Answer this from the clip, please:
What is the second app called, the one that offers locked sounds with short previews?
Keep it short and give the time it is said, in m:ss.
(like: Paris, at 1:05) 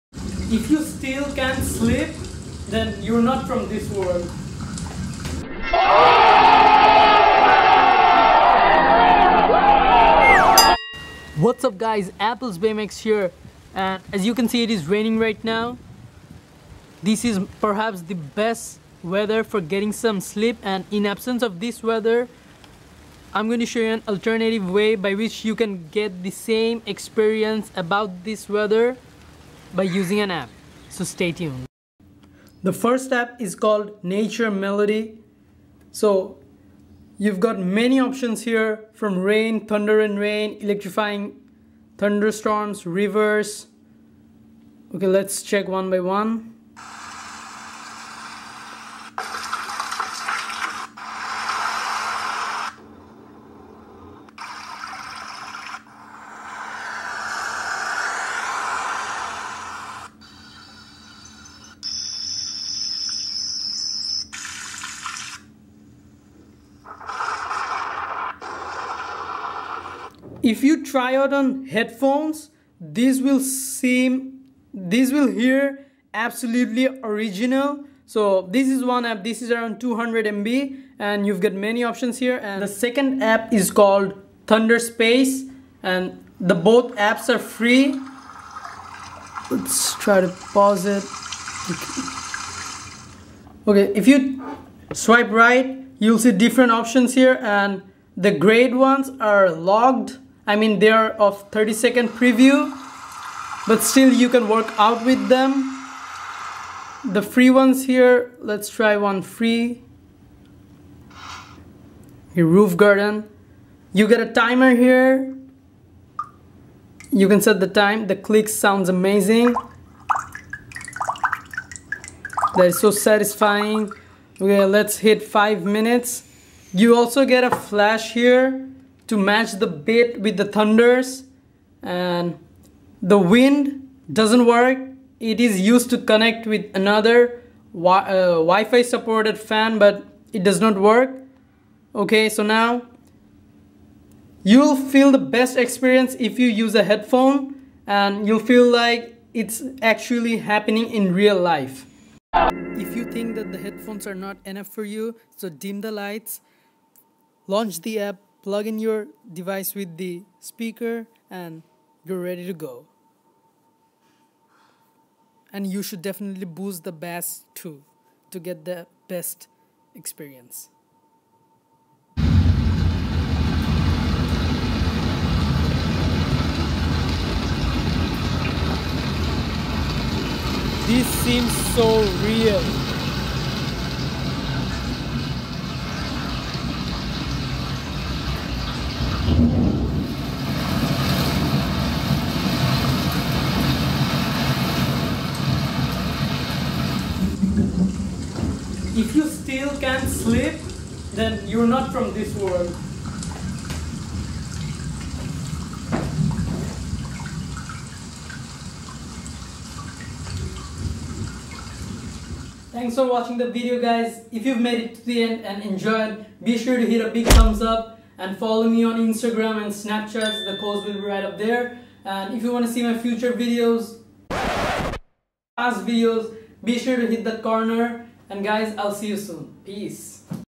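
Thunderspace, at 1:24.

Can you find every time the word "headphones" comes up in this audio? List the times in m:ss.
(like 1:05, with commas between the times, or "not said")
1:11, 2:26, 2:33.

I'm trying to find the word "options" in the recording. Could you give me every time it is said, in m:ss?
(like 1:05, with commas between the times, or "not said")
0:37, 1:21, 1:36.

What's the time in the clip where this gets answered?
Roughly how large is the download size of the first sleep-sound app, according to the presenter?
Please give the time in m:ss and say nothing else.
1:19.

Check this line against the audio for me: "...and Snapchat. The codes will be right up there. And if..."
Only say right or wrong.
right.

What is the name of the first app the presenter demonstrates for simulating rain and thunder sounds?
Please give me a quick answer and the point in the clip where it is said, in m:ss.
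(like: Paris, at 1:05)
Nature Melody, at 0:34.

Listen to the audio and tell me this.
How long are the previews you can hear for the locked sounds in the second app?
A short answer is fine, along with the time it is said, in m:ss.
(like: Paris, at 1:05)
30 seconds, at 1:41.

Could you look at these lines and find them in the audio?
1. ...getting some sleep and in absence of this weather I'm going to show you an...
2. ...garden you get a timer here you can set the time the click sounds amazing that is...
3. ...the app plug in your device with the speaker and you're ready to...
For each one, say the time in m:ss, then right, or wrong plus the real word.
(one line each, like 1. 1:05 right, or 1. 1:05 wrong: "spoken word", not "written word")
1. 0:19 right
2. 1:52 right
3. 2:37 right.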